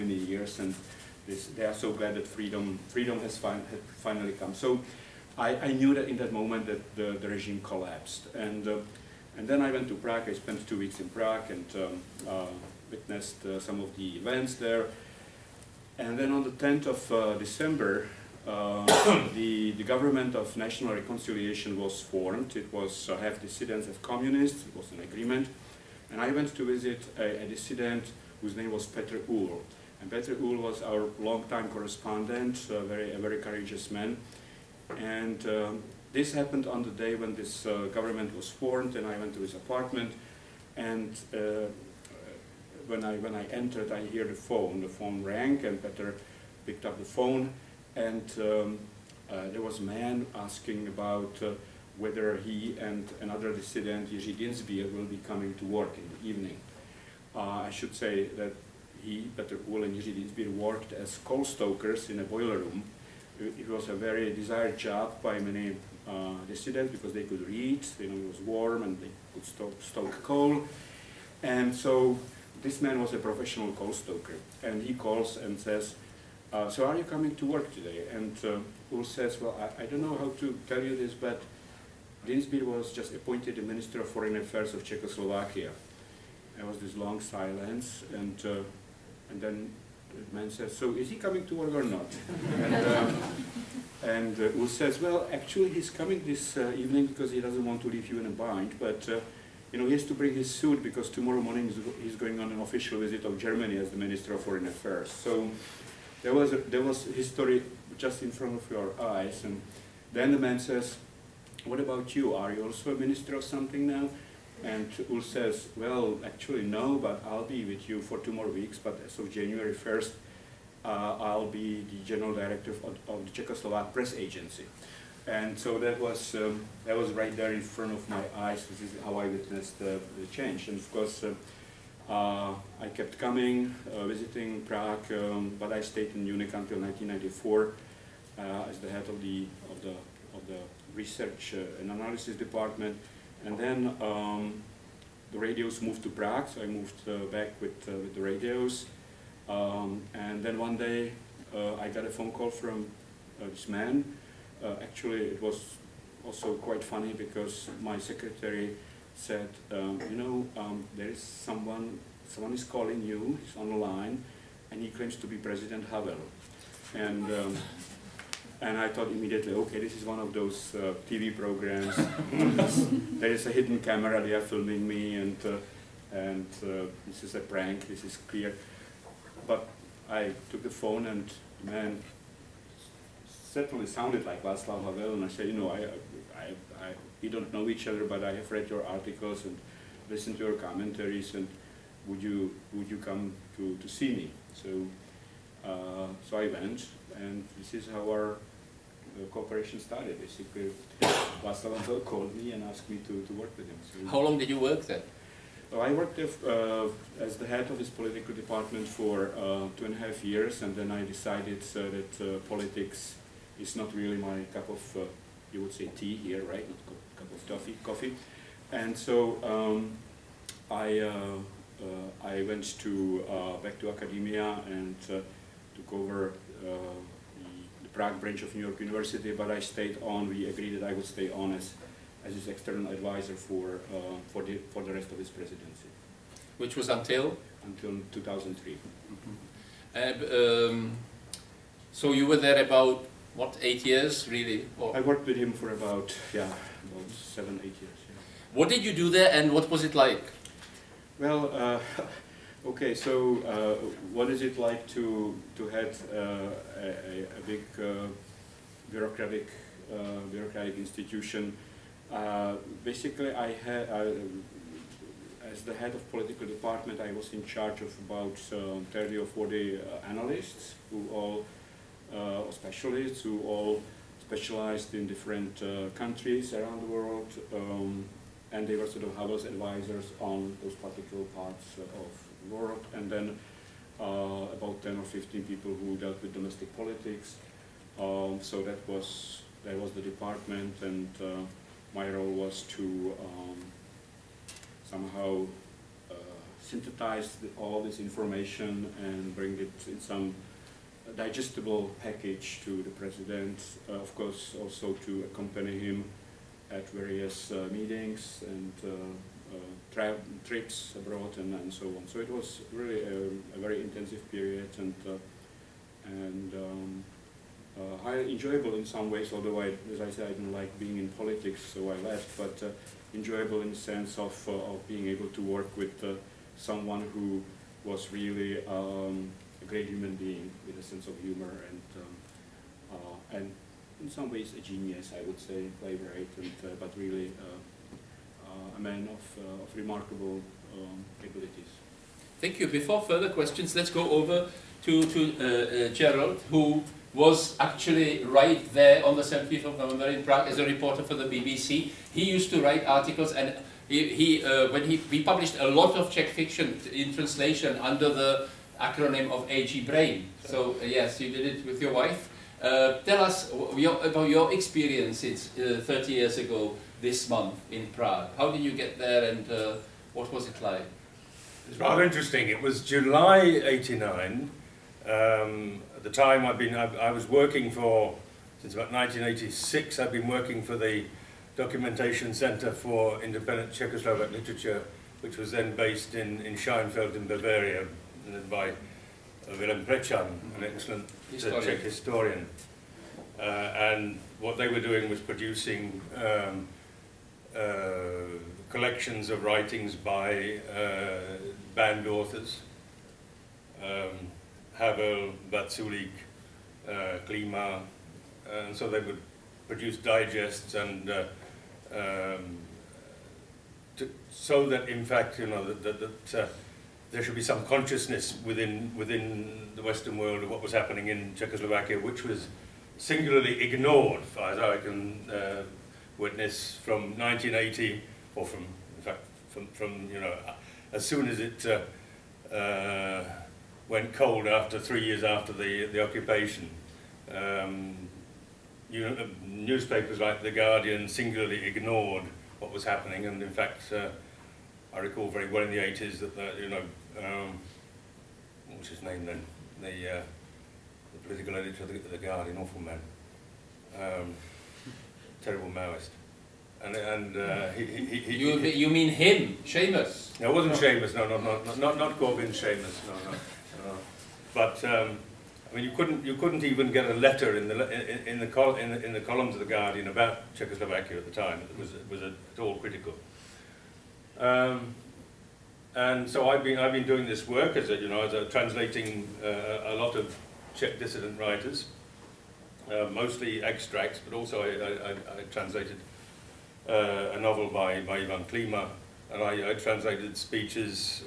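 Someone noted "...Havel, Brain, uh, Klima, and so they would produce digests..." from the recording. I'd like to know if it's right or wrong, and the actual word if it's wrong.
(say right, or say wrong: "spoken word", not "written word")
wrong: "Vaculík", not "Brain".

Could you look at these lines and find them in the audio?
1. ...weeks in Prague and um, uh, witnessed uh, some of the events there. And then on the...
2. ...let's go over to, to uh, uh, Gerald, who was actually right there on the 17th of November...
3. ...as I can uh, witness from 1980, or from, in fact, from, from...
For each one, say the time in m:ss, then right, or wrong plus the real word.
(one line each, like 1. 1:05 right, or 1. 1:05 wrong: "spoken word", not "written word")
1. 0:10 right
2. 5:43 right
3. 7:04 right.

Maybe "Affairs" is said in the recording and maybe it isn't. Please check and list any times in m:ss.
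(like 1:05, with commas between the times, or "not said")
1:24, 1:44.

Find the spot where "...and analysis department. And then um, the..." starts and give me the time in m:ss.
2:21.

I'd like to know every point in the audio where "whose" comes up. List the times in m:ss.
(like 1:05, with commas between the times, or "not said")
0:28.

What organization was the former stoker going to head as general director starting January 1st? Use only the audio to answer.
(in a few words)
Czechoslovak Press Agency.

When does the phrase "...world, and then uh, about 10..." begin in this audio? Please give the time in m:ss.
4:42.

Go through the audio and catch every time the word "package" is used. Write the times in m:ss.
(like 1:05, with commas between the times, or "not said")
5:02.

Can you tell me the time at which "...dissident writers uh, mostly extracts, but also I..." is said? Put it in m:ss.
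8:00.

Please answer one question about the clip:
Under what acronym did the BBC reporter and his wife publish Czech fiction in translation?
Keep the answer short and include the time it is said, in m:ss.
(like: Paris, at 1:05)
AG Brain, at 5:59.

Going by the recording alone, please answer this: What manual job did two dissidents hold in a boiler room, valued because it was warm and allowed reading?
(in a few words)
Coal stokers.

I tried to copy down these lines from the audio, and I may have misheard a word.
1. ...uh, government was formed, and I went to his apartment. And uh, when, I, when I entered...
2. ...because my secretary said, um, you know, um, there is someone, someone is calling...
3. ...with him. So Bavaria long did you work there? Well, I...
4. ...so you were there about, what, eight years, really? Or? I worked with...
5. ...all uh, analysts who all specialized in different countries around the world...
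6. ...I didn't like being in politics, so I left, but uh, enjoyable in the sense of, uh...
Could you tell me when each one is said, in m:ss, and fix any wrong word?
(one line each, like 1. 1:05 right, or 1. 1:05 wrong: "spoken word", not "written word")
1. 0:37 right
2. 2:37 right
3. 3:23 wrong: "How", not "Bavaria"
4. 4:01 right
5. 4:31 wrong: "specialists", not "analysts"
6. 5:20 right.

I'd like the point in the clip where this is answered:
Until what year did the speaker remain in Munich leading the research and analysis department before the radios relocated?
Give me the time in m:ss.
2:16.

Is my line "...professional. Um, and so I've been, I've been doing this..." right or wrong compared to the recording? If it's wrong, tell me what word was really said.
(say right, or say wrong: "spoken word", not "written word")
wrong: "critical", not "professional".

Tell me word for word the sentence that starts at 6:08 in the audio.
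How did you get there and uh, what was it like?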